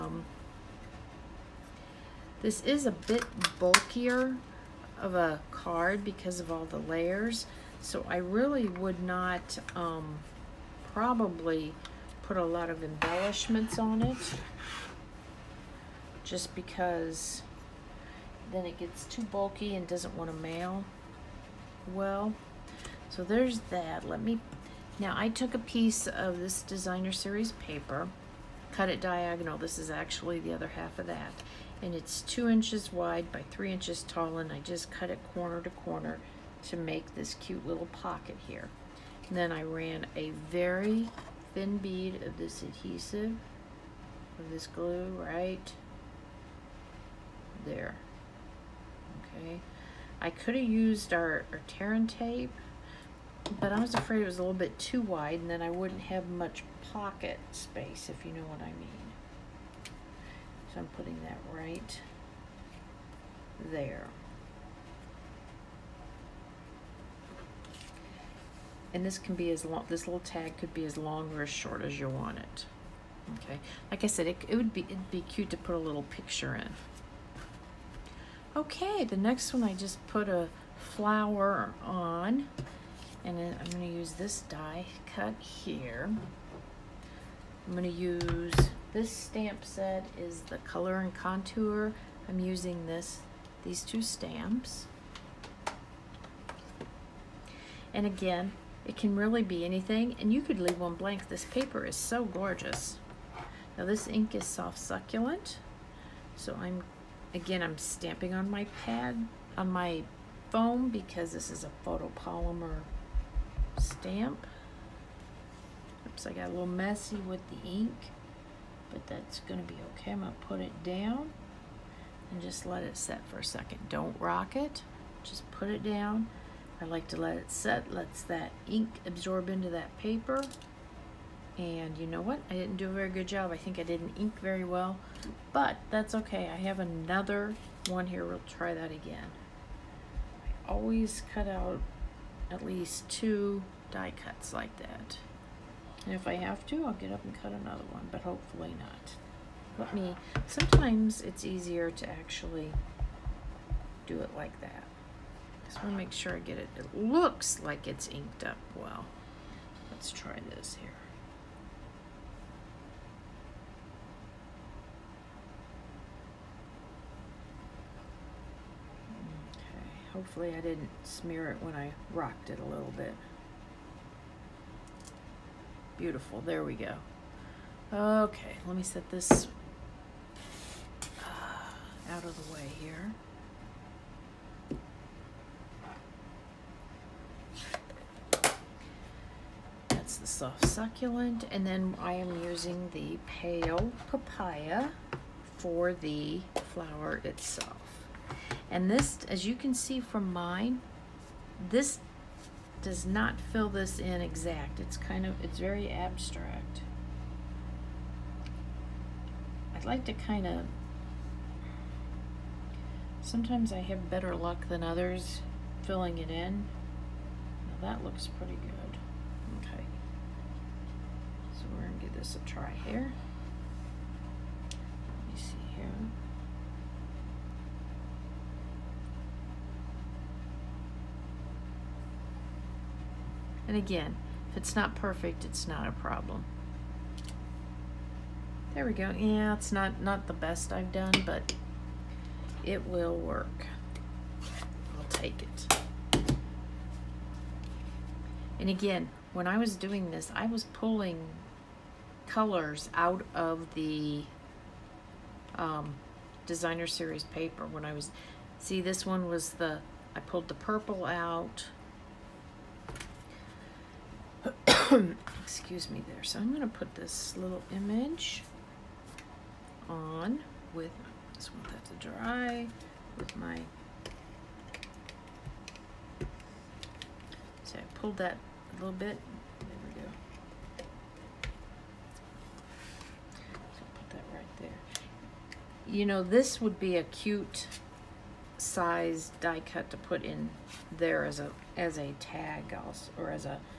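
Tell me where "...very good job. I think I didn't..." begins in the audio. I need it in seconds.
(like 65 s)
132 s.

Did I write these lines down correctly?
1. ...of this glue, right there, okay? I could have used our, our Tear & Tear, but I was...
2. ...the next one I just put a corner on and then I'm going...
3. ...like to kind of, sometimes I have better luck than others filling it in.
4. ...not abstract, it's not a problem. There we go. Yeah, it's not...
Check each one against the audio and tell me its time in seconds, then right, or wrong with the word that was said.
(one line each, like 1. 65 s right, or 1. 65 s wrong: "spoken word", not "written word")
1. 44 s wrong: "Tape", not "Tear"
2. 79 s wrong: "flower", not "corner"
3. 209 s right
4. 234 s wrong: "perfect", not "abstract".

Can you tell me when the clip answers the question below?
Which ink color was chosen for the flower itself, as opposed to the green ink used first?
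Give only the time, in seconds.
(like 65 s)
193 s.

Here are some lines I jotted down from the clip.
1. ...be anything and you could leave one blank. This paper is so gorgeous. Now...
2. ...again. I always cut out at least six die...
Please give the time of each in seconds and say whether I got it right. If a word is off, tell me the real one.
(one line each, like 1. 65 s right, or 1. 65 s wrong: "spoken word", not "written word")
1. 99 s right
2. 138 s wrong: "two", not "six".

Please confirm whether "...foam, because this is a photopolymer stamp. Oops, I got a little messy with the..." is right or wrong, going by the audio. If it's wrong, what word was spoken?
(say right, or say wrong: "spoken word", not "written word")
right.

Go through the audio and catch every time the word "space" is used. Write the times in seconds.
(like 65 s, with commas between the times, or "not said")
57 s.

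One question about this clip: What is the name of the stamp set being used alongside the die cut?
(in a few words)
Color and Contour.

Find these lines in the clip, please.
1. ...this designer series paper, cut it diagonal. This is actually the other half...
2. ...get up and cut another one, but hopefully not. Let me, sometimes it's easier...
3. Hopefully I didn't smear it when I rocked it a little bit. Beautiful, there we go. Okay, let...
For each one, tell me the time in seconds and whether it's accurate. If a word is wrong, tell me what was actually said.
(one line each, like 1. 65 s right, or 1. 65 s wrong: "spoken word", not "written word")
1. 26 s right
2. 146 s right
3. 170 s right.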